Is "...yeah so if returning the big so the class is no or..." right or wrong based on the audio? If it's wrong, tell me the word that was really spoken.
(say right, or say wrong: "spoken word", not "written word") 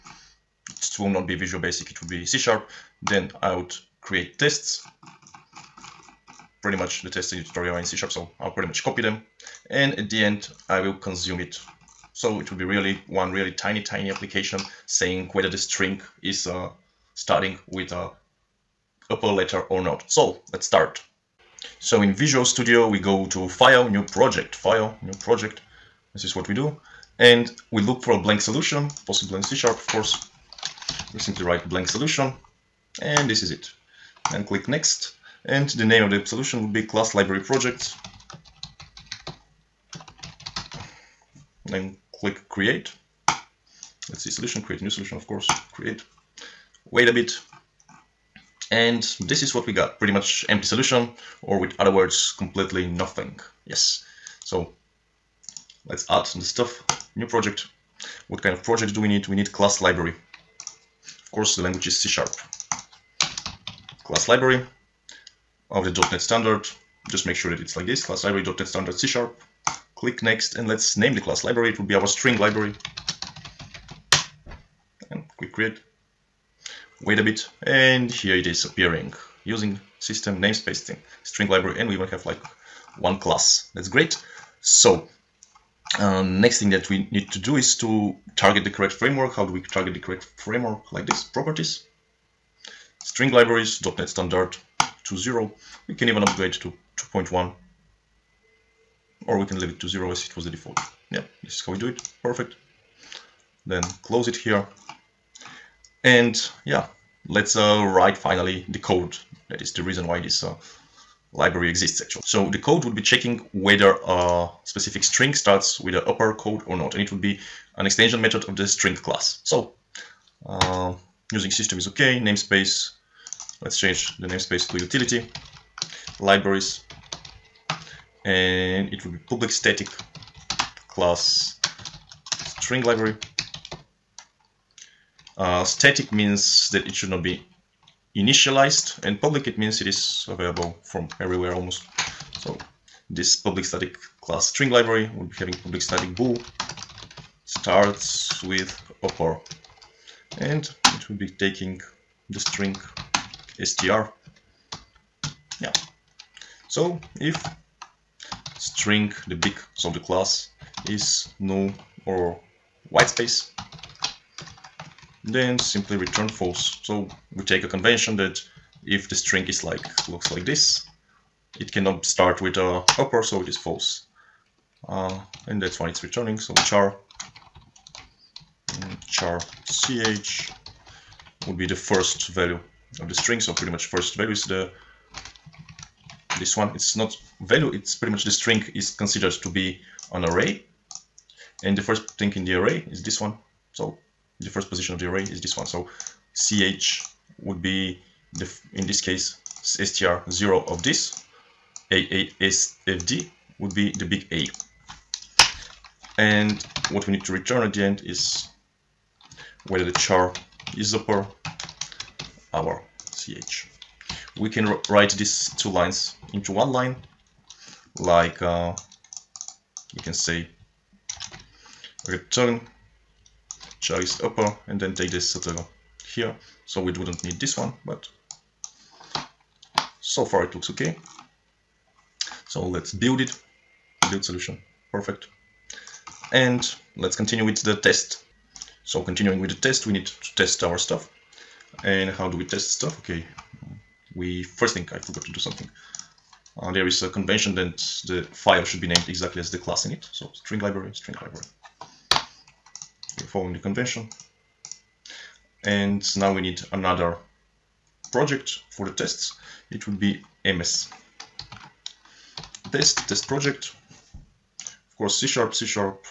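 wrong: "string", not "returning".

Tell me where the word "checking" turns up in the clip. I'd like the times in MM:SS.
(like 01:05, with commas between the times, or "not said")
01:53.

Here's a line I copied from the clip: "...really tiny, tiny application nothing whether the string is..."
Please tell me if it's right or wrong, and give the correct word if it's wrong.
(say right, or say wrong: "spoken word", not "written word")
wrong: "saying", not "nothing".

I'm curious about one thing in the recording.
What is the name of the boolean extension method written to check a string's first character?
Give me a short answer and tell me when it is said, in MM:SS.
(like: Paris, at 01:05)
starts with upper, at 02:27.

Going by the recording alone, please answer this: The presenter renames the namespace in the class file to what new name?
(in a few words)
utility libraries.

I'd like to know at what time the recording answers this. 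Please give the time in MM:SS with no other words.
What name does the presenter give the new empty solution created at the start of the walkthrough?
00:36.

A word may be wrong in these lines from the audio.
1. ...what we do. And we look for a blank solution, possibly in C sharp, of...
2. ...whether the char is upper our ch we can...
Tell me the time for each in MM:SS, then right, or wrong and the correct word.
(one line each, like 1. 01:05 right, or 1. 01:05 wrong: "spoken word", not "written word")
1. 00:26 right
2. 03:29 right.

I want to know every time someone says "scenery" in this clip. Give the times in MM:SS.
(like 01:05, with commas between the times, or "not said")
not said.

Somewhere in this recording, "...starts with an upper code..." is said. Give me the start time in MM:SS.
01:55.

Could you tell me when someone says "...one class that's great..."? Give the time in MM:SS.
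01:22.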